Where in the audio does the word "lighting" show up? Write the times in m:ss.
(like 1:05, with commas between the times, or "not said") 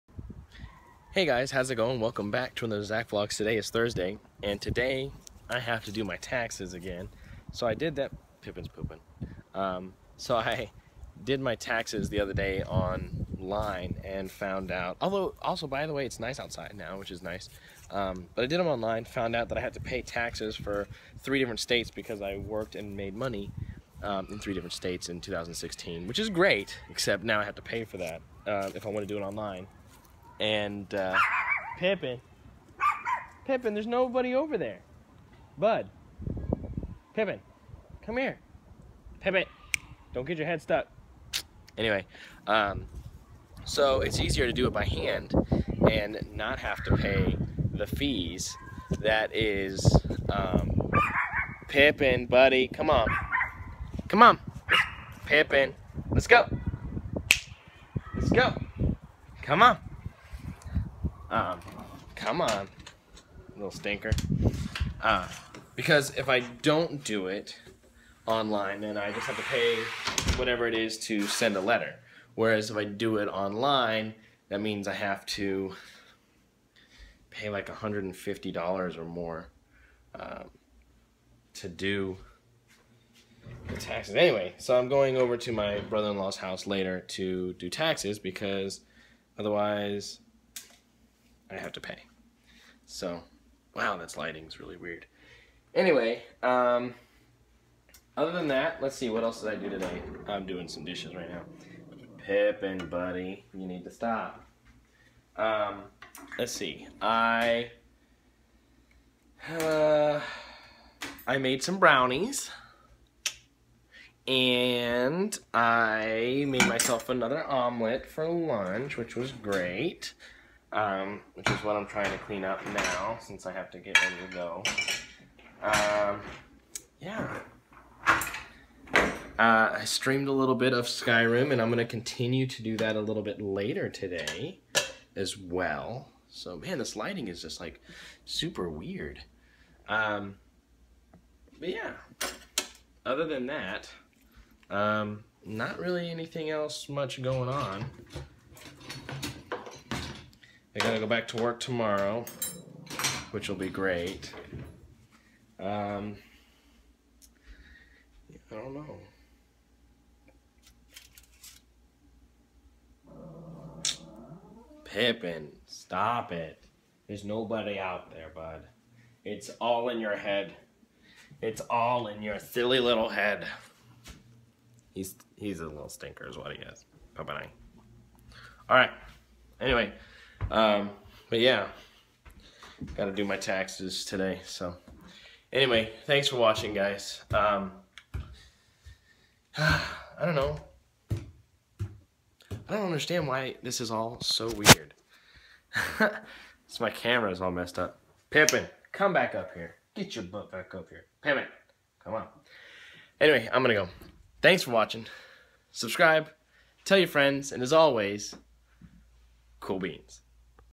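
1:34, 2:16.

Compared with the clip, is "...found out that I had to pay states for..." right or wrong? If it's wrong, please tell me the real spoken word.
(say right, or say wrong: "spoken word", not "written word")
wrong: "taxes", not "states".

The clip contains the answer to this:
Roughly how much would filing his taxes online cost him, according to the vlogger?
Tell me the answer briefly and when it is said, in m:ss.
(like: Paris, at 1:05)
$150, at 1:17.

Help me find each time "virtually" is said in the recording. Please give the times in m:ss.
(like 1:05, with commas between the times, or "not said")
not said.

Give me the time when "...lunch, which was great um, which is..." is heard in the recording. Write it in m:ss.
1:58.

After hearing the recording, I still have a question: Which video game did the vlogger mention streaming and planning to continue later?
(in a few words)
Skyrim.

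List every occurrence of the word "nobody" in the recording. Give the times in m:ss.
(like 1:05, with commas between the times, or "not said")
0:33, 2:47.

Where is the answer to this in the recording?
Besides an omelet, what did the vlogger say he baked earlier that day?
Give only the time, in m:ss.
1:51.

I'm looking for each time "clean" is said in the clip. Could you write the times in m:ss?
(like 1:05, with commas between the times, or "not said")
2:02.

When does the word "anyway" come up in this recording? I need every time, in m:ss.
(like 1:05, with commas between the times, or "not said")
0:41, 1:24, 1:35, 2:59, 3:05, 3:23.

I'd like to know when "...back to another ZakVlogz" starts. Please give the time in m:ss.
0:02.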